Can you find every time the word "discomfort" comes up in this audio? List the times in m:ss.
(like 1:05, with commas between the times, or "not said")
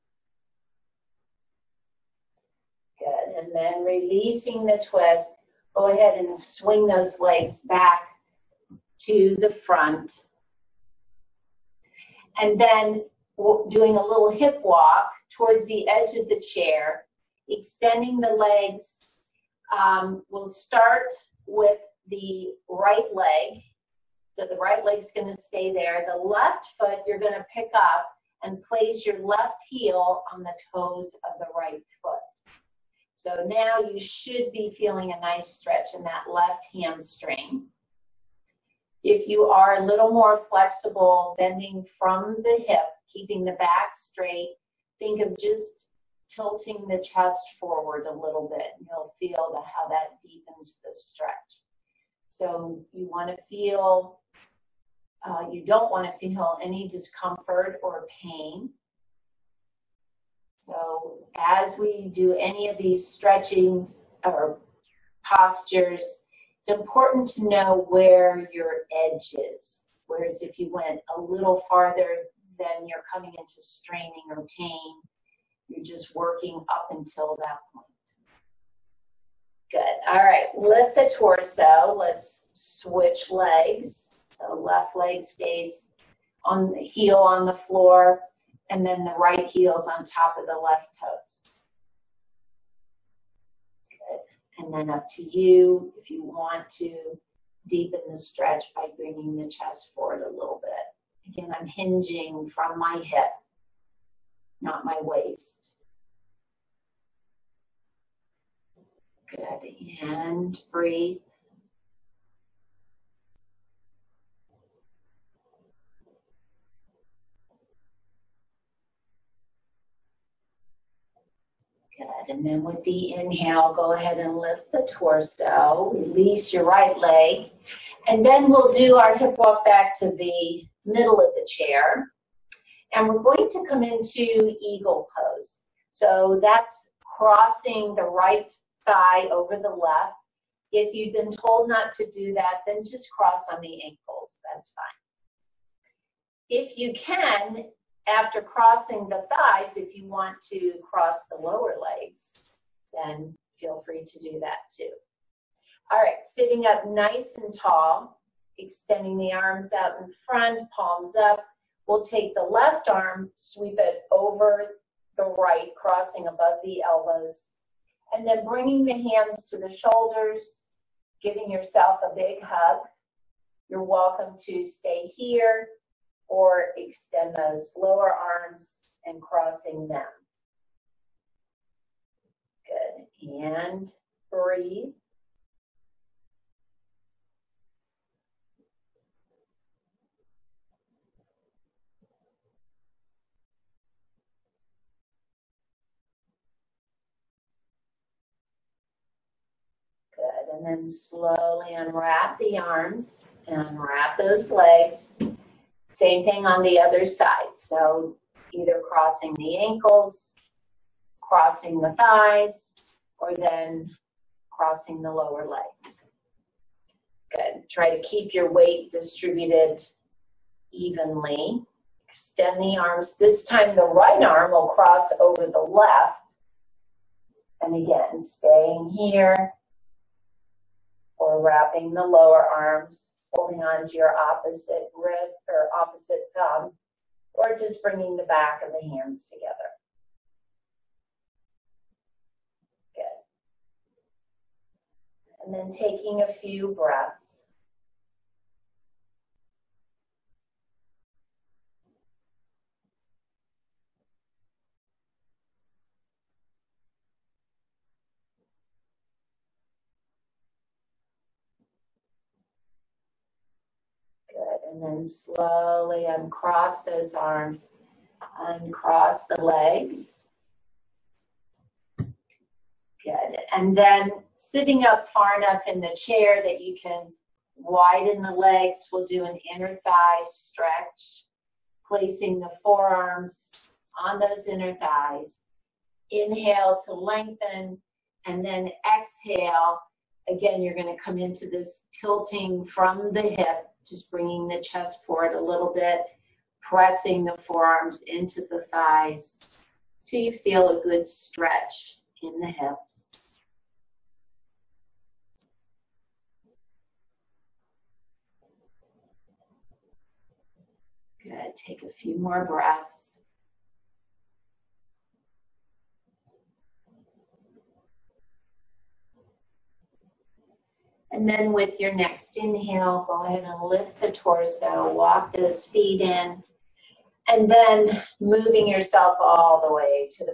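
0:56.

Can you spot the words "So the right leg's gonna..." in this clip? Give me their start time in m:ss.
0:24.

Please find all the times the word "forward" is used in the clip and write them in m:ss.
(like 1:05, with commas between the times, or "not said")
0:47, 1:39, 4:55.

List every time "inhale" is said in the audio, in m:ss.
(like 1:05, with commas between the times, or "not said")
2:03, 4:46, 5:22.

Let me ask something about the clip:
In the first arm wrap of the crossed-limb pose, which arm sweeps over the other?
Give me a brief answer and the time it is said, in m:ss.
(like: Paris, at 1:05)
left arm, at 2:42.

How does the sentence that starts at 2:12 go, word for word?
And we're going to come into eagle pose.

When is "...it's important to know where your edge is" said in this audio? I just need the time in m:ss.
1:06.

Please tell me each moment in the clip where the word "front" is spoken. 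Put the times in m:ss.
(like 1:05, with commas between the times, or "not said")
0:09, 2:40.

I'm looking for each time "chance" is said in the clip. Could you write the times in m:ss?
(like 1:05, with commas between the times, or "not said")
not said.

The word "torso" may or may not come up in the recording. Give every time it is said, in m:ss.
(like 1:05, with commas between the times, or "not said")
1:21, 2:04, 5:24.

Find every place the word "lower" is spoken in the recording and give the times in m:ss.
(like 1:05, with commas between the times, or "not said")
2:31, 2:57, 3:35, 3:52.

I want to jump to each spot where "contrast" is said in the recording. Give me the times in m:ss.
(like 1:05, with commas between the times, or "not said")
not said.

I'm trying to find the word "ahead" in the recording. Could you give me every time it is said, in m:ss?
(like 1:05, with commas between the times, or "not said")
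0:05, 2:03, 5:23.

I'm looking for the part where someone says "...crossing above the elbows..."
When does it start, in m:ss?
2:45.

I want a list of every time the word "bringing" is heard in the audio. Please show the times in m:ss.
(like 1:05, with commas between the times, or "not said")
1:38, 2:48, 3:57, 4:54.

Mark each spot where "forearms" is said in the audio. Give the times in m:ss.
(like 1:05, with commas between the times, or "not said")
4:42, 4:57.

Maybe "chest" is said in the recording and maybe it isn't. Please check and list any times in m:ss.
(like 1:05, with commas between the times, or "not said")
0:46, 1:39, 4:54.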